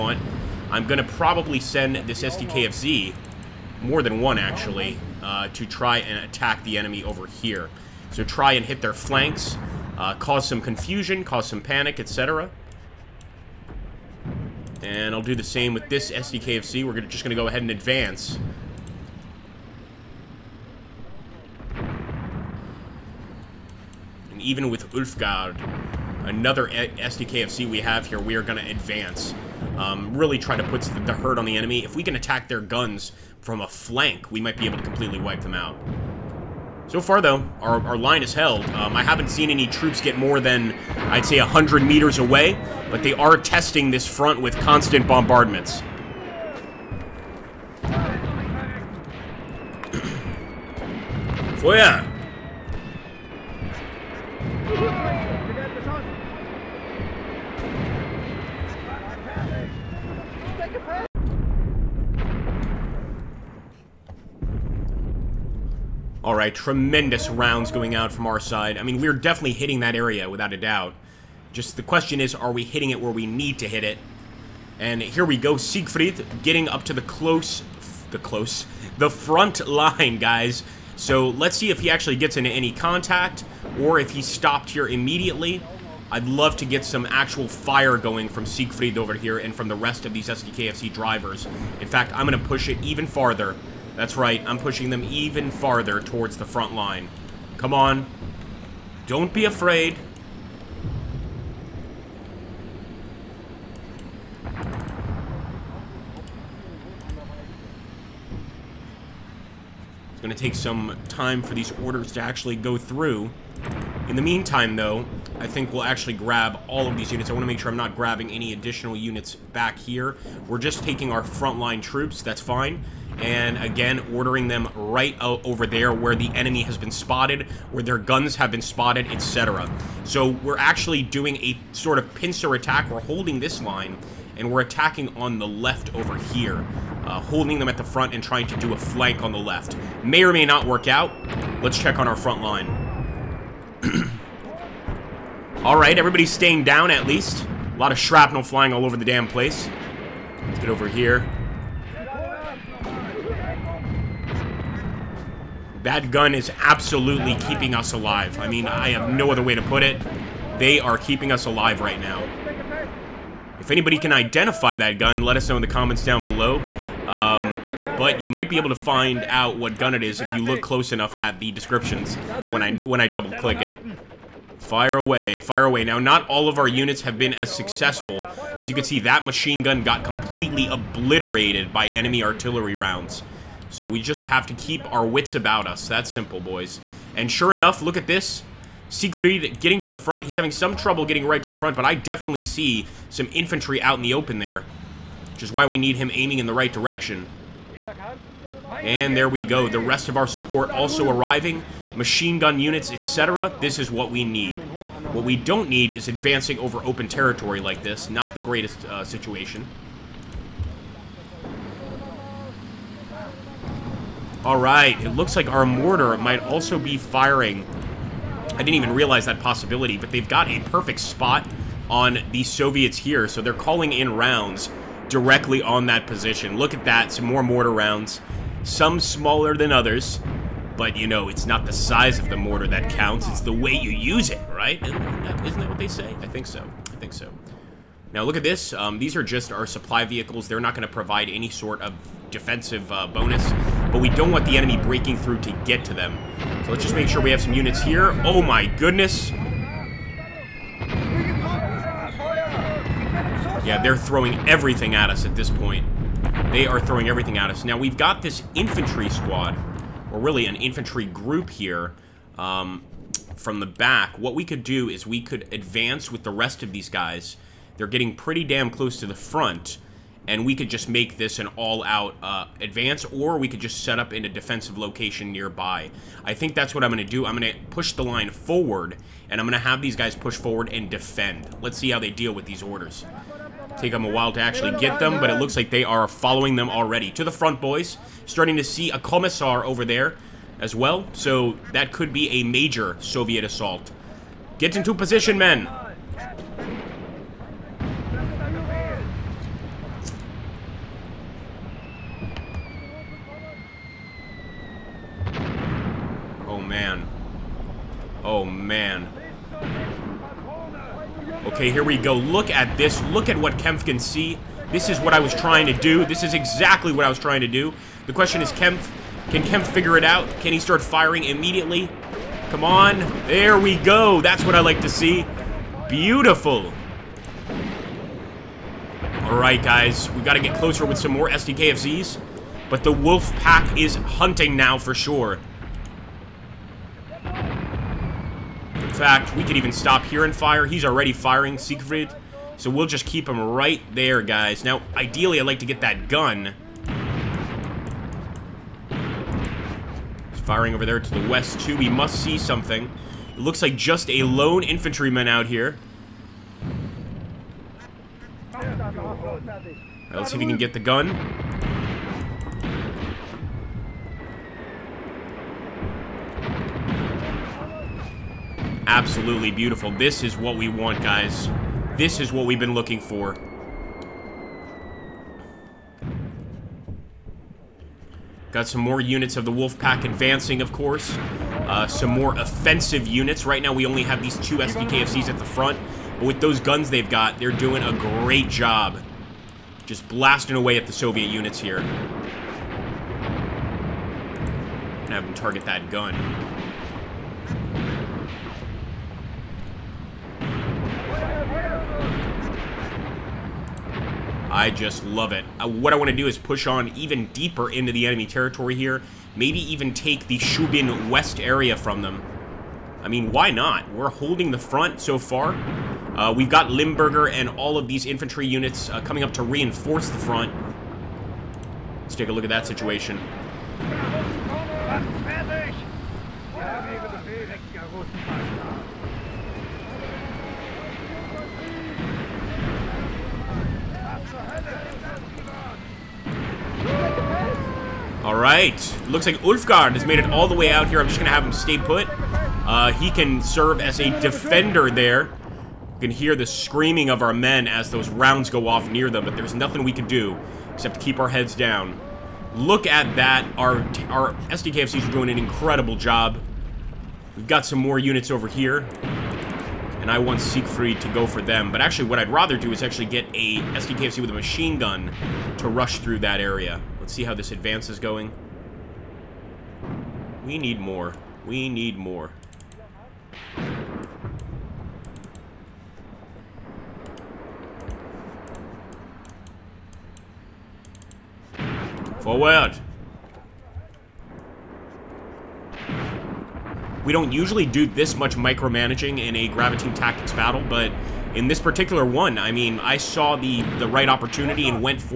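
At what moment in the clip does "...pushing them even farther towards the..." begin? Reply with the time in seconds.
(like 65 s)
94 s.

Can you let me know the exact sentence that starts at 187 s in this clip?
And sure enough, look at this.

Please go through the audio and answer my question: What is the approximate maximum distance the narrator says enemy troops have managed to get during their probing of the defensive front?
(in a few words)
100 meters.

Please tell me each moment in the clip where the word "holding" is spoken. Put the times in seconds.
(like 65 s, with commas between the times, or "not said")
133 s, 137 s, 414 s.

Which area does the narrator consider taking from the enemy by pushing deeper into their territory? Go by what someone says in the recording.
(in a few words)
Shubin West.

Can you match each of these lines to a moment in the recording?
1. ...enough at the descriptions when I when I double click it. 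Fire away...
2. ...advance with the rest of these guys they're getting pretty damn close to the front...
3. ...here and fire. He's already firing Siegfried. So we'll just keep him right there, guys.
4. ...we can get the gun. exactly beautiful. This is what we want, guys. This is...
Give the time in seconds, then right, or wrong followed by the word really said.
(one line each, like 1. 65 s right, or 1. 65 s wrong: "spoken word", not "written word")
1. 170 s right
2. 265 s right
3. 340 s right
4. 360 s wrong: "absolutely", not "exactly".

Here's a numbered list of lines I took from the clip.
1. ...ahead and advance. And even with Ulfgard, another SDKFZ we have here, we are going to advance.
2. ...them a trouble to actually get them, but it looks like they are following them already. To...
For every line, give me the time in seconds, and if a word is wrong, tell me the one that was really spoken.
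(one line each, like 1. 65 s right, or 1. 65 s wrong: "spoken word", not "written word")
1. 17 s right
2. 283 s wrong: "while", not "trouble".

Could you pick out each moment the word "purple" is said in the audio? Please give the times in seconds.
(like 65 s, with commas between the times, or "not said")
not said.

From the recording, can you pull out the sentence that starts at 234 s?
Isn't that, isn't that what they say?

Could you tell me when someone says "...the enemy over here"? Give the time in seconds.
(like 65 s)
6 s.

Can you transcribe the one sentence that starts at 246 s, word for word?
So let's just make sure we have some units here.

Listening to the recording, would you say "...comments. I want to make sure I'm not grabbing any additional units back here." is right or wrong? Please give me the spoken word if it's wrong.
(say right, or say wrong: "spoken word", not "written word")
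wrong: "units", not "comments".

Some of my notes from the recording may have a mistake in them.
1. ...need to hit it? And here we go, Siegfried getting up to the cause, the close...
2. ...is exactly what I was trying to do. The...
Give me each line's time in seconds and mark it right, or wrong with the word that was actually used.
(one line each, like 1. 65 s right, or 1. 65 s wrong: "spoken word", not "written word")
1. 73 s wrong: "close", not "cause"
2. 316 s right.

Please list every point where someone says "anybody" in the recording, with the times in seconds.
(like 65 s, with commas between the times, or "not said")
163 s.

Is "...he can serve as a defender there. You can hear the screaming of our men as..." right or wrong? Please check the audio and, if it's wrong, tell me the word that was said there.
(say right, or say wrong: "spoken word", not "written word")
right.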